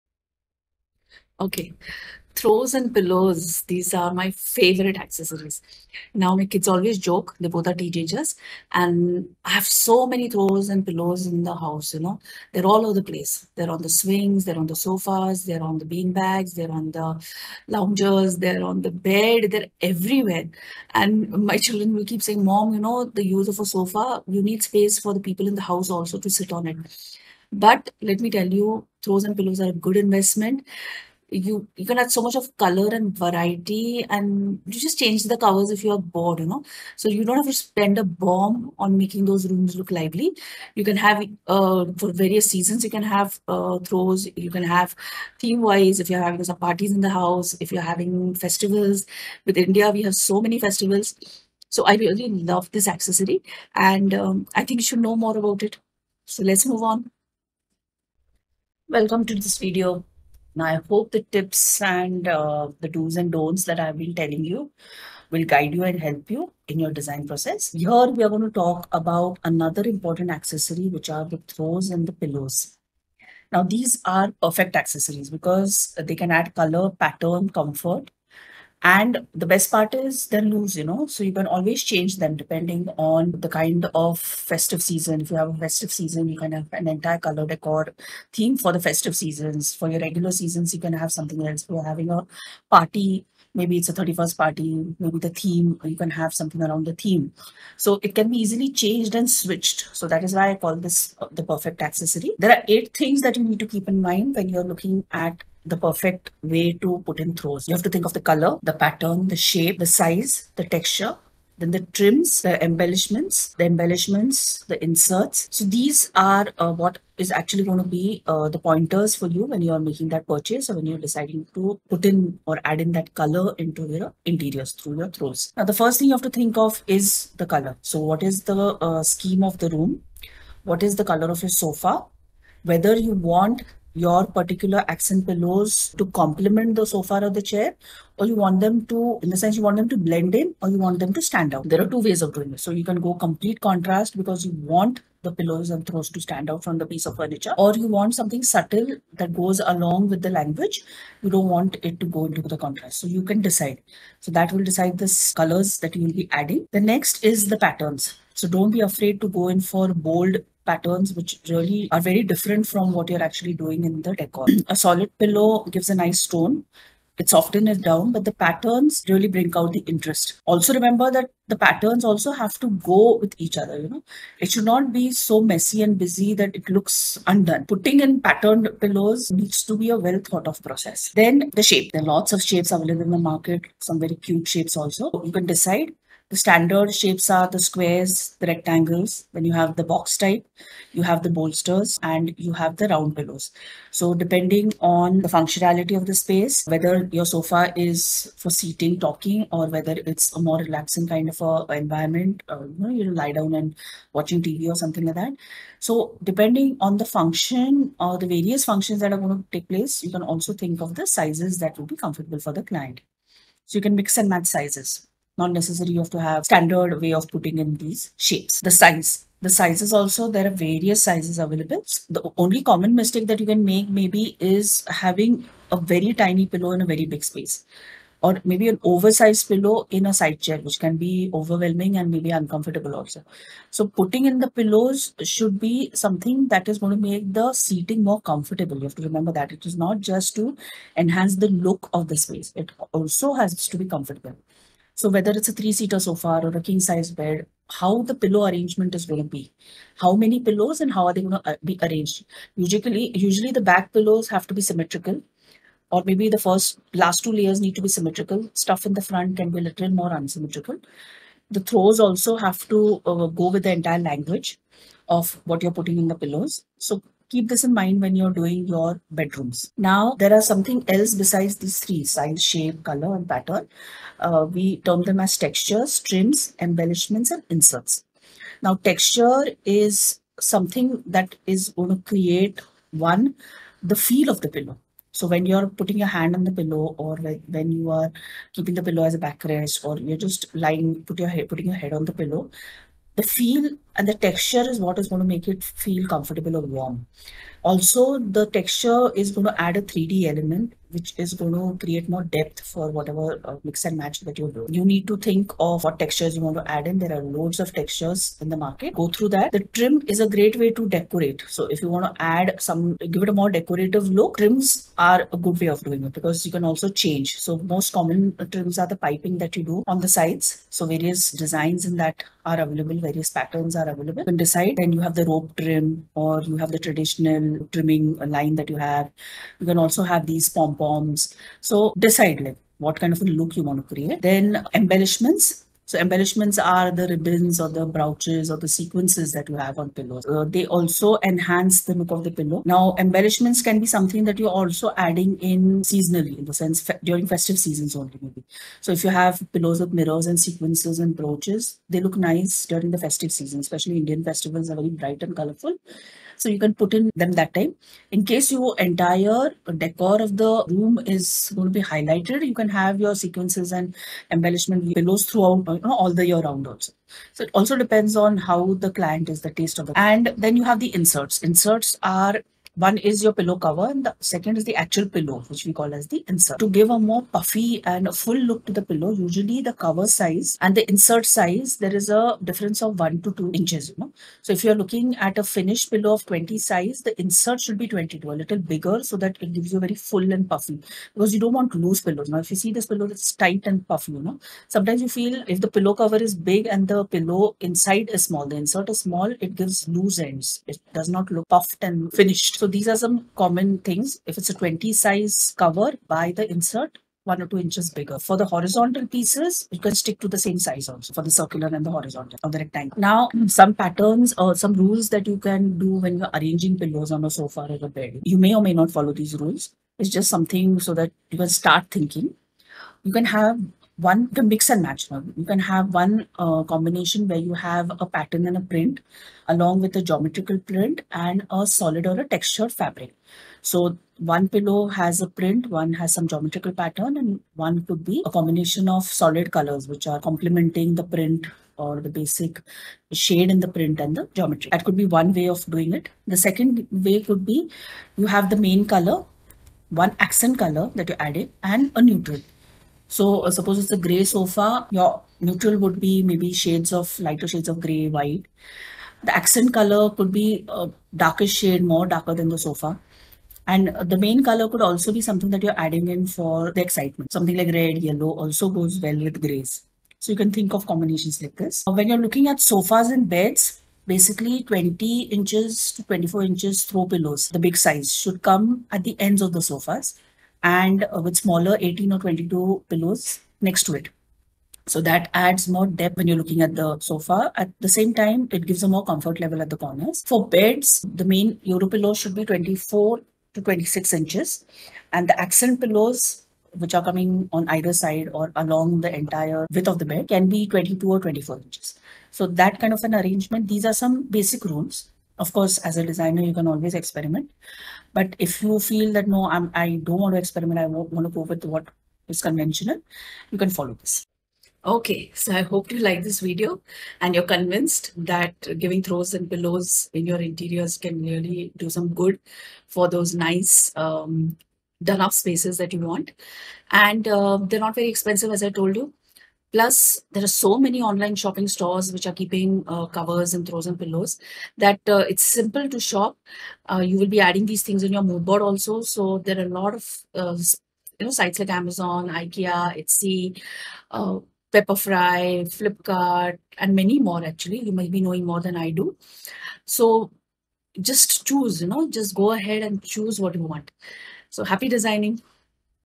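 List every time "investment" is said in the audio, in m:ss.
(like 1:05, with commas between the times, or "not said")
0:29.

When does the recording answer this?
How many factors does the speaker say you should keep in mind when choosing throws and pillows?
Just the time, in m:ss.
1:42.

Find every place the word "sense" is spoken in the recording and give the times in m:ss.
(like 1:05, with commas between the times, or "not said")
2:19, 5:46.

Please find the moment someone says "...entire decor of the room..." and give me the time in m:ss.
5:58.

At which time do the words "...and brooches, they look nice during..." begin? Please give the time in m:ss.
5:50.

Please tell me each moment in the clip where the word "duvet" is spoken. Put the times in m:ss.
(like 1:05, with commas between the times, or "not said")
not said.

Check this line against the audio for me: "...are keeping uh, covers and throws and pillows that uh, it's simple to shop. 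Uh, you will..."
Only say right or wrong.
right.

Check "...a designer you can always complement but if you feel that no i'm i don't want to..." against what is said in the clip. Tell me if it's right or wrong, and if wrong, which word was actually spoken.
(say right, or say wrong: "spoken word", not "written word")
wrong: "experiment", not "complement".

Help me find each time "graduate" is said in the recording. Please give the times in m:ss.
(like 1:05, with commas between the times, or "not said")
not said.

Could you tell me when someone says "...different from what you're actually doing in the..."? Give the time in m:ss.
2:42.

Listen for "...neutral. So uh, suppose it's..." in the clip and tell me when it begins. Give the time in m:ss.
7:32.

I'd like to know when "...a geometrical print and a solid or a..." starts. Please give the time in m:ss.
7:09.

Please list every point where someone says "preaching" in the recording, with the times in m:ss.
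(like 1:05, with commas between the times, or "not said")
not said.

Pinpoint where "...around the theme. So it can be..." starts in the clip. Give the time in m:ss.
1:36.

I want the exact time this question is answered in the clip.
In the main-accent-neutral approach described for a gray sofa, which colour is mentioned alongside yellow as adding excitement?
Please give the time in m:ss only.
7:47.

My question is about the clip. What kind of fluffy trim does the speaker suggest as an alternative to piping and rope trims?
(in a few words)
pom-poms.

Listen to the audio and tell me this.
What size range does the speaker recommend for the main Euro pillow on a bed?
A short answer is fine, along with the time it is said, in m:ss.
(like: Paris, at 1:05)
24 to 26 inches, at 8:12.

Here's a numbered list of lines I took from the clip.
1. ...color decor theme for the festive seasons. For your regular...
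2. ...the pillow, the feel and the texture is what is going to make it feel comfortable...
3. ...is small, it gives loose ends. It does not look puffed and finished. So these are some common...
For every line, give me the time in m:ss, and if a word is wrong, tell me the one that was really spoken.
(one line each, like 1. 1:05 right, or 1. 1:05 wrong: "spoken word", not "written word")
1. 1:27 right
2. 4:52 right
3. 6:38 right.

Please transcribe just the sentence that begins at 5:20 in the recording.
So various designs in that are available, various patterns are are available.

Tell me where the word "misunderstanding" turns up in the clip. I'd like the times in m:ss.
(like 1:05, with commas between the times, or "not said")
not said.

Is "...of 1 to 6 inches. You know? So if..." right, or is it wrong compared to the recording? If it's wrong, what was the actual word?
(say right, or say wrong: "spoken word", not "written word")
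wrong: "2", not "6".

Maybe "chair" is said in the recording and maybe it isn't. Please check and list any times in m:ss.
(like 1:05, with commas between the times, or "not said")
2:17, 3:50.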